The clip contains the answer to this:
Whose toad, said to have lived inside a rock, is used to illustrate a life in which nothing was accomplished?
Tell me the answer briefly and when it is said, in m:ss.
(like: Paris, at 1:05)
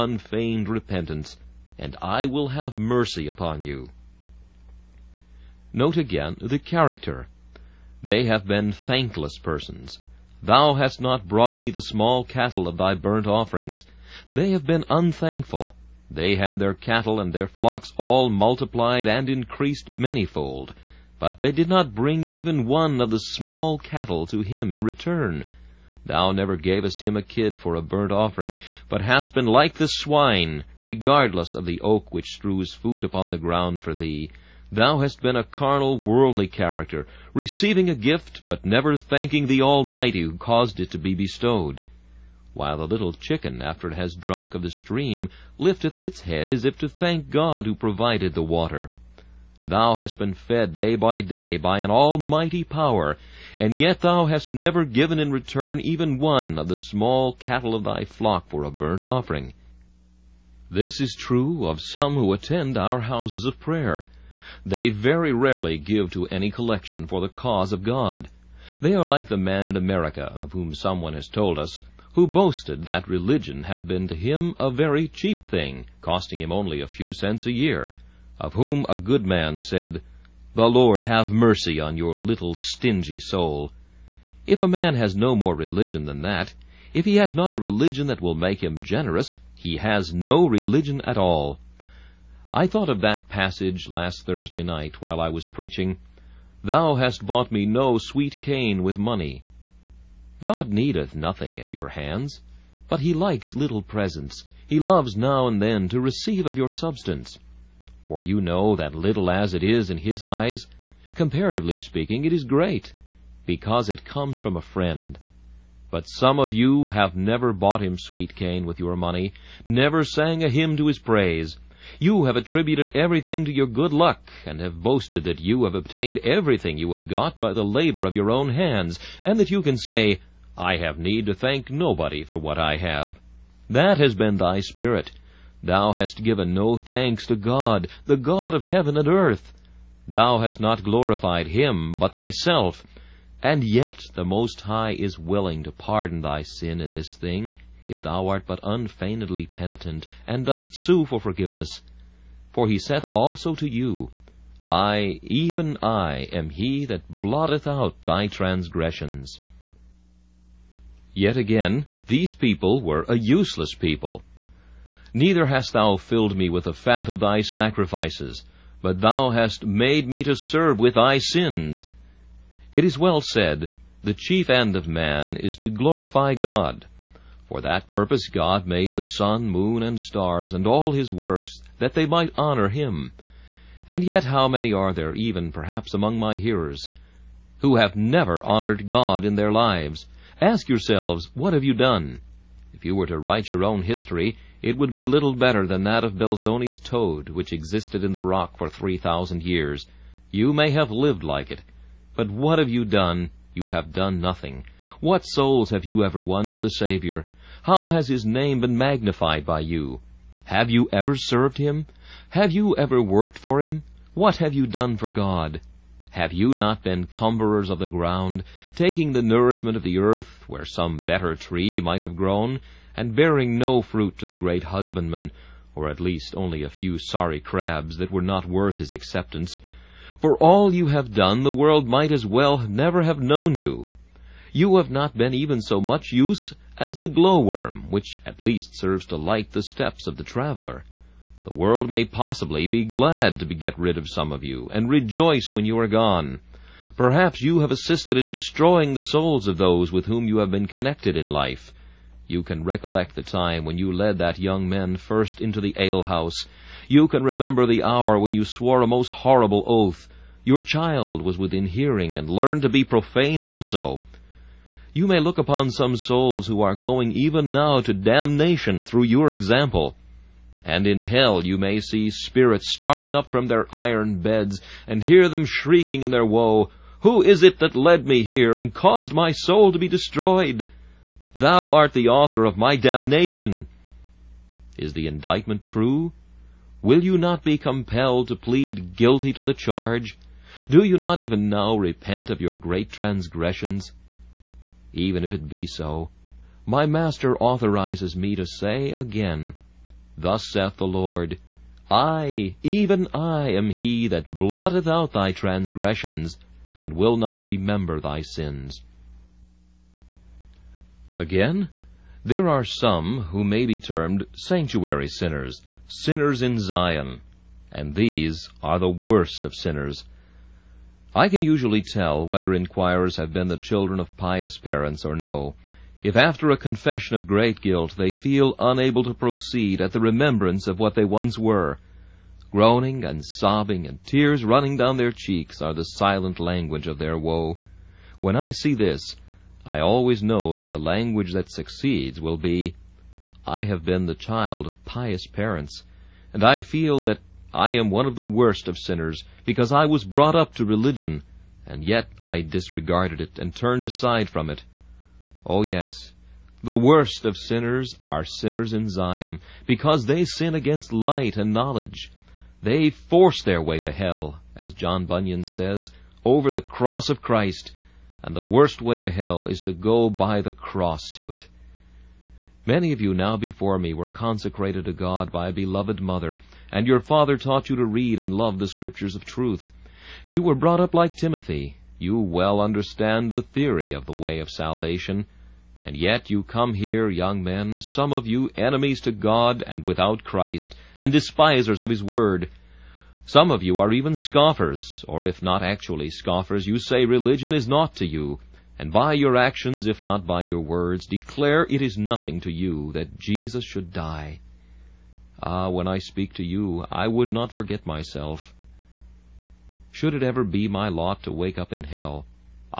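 Belzoni, at 3:16.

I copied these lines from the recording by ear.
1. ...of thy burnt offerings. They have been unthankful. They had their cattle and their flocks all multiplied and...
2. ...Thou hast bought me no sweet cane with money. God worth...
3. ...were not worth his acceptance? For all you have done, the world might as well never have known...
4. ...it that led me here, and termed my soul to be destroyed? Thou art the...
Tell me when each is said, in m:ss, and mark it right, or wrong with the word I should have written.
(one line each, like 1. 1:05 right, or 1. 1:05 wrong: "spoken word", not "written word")
1. 0:12 right
2. 1:36 wrong: "needeth", not "worth"
3. 3:48 right
4. 4:37 wrong: "caused", not "termed".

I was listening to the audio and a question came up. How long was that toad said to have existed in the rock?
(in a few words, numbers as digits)
3000 years.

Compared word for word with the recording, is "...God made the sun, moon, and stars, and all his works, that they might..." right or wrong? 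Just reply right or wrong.
right.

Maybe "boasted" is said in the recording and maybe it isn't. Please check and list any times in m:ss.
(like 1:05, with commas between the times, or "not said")
1:12, 2:04.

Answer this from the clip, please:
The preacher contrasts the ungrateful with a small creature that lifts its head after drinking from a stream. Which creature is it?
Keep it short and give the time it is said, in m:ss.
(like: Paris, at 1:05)
little chicken, at 0:42.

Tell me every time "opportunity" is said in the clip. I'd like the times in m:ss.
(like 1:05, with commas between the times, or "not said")
not said.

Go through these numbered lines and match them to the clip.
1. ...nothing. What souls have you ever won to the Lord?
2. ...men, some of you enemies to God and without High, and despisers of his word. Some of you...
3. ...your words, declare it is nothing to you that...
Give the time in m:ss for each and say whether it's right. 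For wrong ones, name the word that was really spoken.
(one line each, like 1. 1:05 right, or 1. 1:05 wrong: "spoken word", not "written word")
1. 3:24 wrong: "Savior", not "Lord"
2. 6:27 wrong: "Christ", not "High"
3. 6:40 right.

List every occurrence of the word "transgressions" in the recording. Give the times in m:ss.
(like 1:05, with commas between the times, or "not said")
2:38, 4:52, 5:05.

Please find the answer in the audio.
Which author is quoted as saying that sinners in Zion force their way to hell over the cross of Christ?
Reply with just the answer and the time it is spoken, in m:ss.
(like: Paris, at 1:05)
John Bunyan, at 6:04.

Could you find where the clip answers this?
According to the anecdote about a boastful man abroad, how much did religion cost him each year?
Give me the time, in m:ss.
1:16.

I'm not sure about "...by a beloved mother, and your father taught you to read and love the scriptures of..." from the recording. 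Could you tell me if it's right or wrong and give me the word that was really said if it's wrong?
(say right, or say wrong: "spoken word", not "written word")
right.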